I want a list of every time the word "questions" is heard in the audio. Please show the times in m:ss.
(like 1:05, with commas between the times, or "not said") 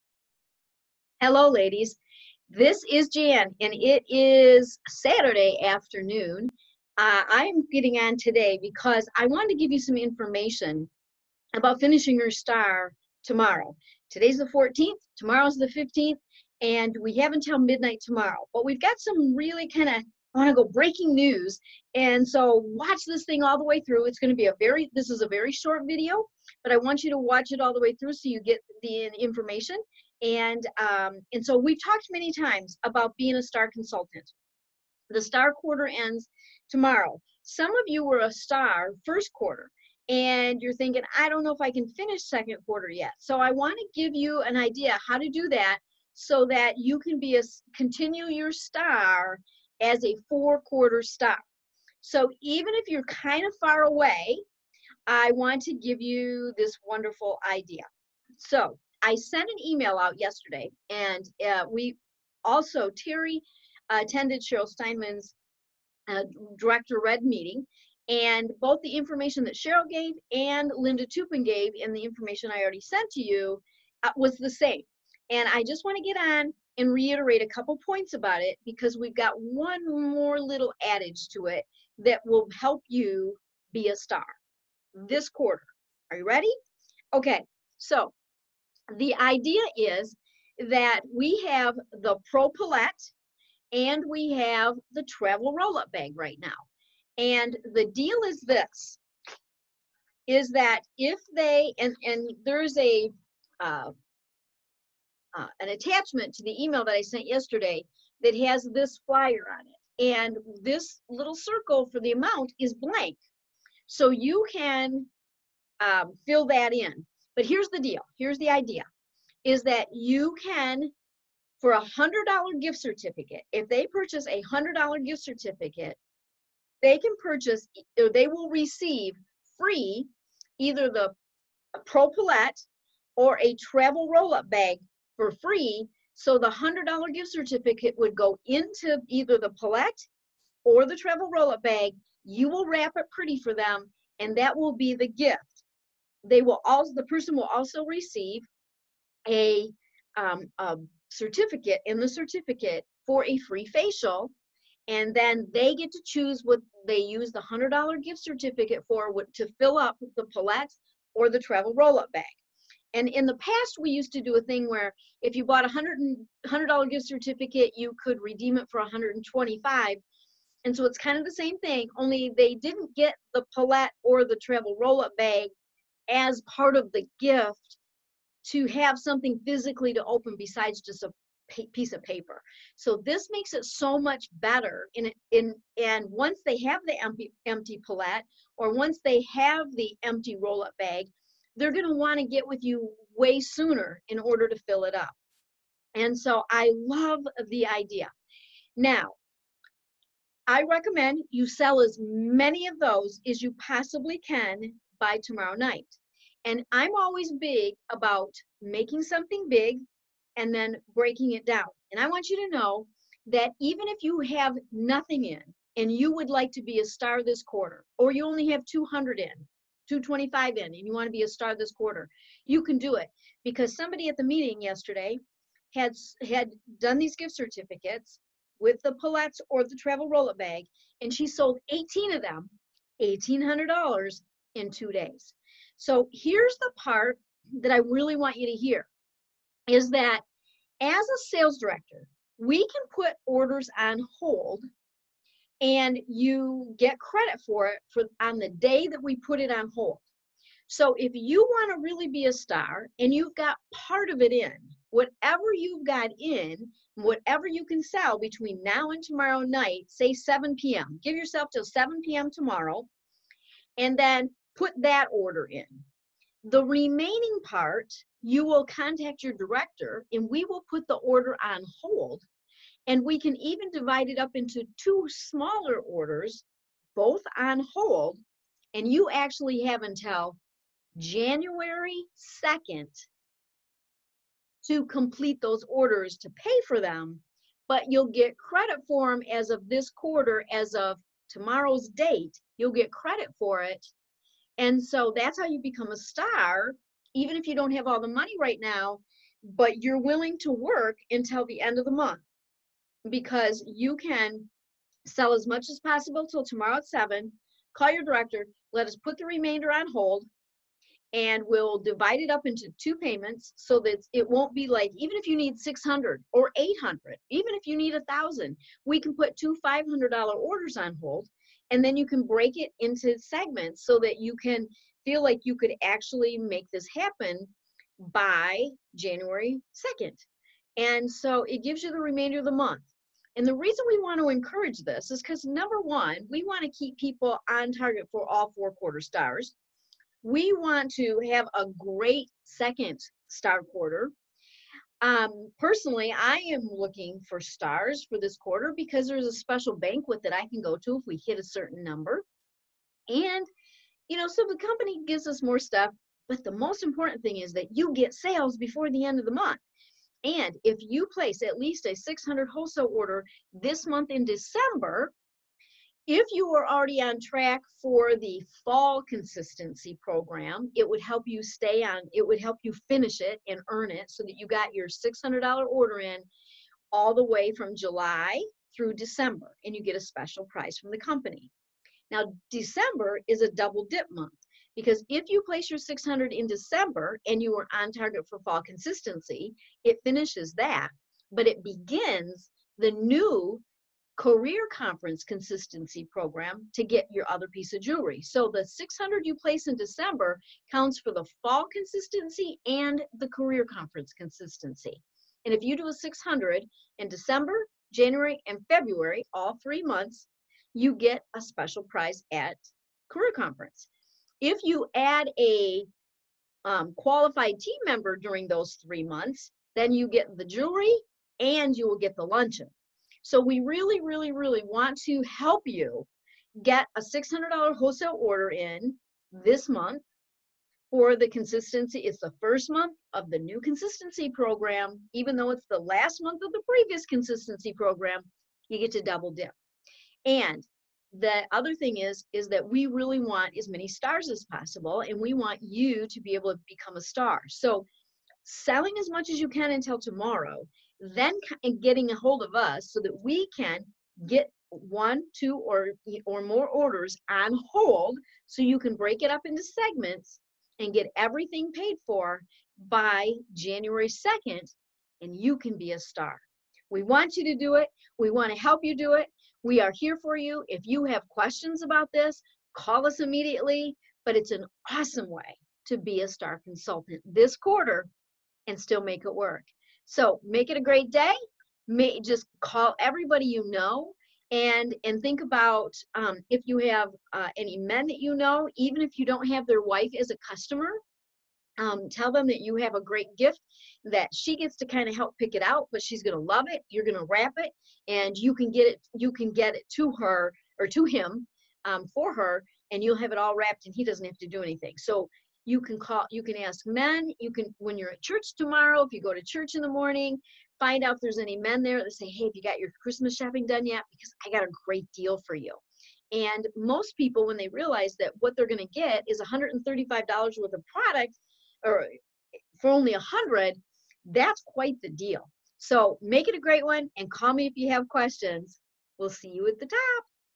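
7:51, 8:48.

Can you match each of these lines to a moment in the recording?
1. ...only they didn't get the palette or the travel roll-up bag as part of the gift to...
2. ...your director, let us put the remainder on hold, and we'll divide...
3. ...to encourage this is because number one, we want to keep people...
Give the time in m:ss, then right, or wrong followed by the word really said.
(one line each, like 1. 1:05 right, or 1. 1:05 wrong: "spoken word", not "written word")
1. 2:51 right
2. 5:07 right
3. 5:34 right.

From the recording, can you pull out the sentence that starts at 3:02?
So this makes it so much better.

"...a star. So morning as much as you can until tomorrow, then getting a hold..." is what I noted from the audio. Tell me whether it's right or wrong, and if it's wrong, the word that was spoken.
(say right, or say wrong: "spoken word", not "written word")
wrong: "selling", not "morning".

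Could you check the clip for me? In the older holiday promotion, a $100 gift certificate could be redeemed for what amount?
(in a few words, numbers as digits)
$125.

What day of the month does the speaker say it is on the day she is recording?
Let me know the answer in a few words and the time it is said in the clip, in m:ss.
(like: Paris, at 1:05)
14th, at 0:14.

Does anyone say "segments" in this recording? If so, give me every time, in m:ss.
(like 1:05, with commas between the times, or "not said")
5:23, 7:39.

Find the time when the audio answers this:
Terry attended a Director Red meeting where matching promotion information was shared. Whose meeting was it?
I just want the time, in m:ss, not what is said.
1:04.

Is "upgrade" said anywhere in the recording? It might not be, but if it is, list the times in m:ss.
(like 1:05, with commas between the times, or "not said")
not said.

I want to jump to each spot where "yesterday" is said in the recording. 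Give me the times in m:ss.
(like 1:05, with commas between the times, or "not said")
1:00, 1:47, 3:44.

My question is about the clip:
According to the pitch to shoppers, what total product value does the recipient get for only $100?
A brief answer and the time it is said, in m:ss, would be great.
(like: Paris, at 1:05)
$135, at 8:39.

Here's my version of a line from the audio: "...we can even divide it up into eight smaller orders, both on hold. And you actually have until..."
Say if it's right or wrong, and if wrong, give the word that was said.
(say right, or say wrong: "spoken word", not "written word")
wrong: "two", not "eight".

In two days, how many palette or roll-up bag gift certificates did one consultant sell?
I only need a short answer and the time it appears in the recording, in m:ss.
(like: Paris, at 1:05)
18, at 3:51.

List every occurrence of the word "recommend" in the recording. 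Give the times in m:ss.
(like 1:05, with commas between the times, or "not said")
3:20.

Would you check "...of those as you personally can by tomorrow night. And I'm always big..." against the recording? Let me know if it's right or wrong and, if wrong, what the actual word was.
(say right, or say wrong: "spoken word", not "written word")
wrong: "possibly", not "personally".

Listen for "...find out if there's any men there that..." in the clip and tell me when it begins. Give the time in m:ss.
8:30.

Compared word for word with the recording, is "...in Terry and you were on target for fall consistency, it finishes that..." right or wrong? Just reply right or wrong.
wrong.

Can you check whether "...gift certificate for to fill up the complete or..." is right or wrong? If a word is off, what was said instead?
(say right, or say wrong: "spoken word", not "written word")
wrong: "palette", not "complete".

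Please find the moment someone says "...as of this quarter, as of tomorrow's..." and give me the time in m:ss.
4:49.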